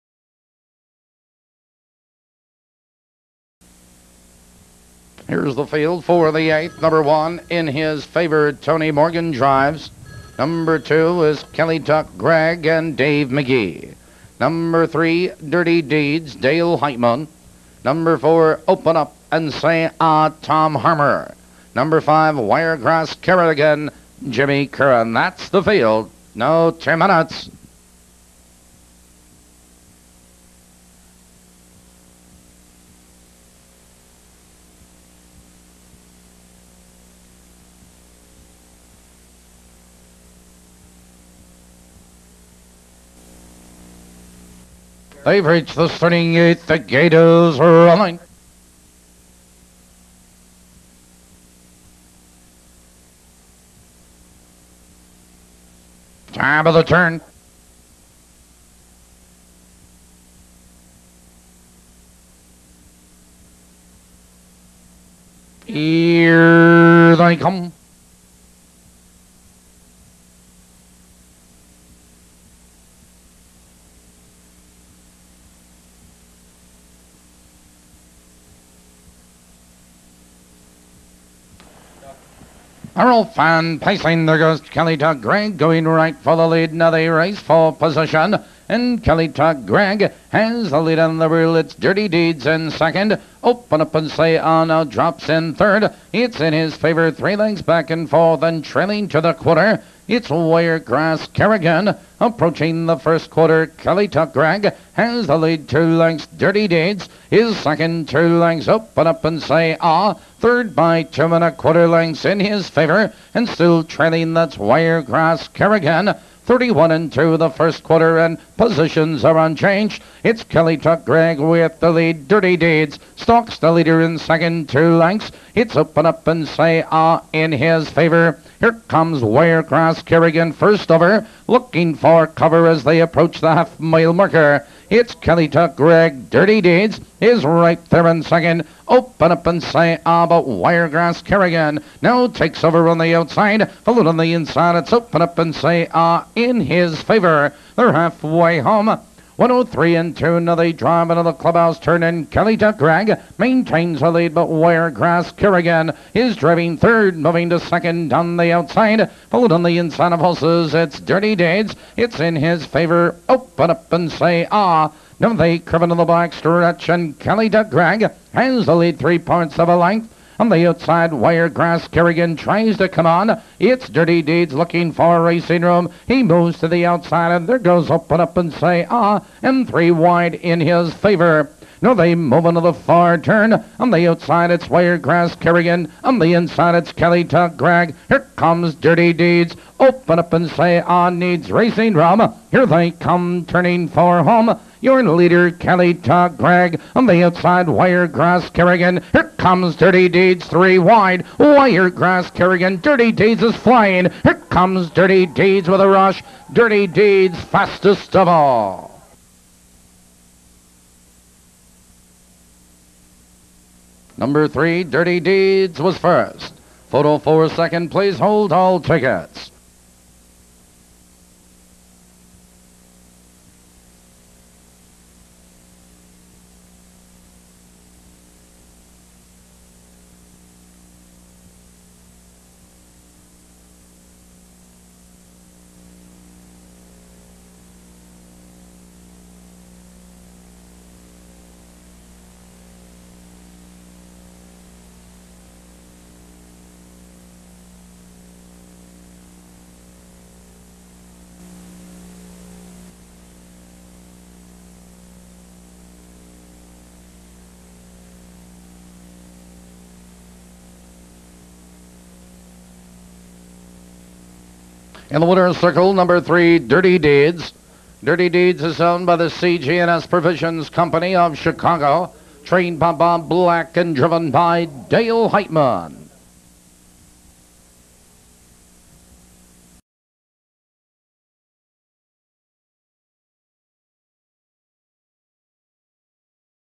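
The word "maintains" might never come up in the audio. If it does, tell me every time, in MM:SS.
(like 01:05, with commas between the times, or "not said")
02:33.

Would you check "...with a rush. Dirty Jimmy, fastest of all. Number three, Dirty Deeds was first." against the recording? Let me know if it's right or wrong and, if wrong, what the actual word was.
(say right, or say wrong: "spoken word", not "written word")
wrong: "Deeds", not "Jimmy".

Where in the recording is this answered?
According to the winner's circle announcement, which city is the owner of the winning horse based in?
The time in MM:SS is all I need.
04:31.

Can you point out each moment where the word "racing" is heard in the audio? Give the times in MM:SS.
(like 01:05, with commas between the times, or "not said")
02:55, 03:11.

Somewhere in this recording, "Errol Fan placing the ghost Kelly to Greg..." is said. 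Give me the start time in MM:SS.
01:22.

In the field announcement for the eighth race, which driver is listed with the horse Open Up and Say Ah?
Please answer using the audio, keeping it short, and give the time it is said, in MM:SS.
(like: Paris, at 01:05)
Tom Harmer, at 00:20.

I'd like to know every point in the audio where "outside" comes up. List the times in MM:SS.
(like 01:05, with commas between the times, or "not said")
02:23, 02:38, 02:50, 02:56, 03:04, 03:17.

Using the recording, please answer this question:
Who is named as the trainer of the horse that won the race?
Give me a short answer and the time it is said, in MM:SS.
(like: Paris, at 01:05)
Bob Black, at 04:32.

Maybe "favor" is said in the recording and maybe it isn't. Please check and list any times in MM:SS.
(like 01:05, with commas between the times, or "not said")
00:08, 01:36, 01:52, 02:07, 02:27, 02:42, 03:00.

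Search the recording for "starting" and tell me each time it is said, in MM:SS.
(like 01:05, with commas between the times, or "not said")
00:45.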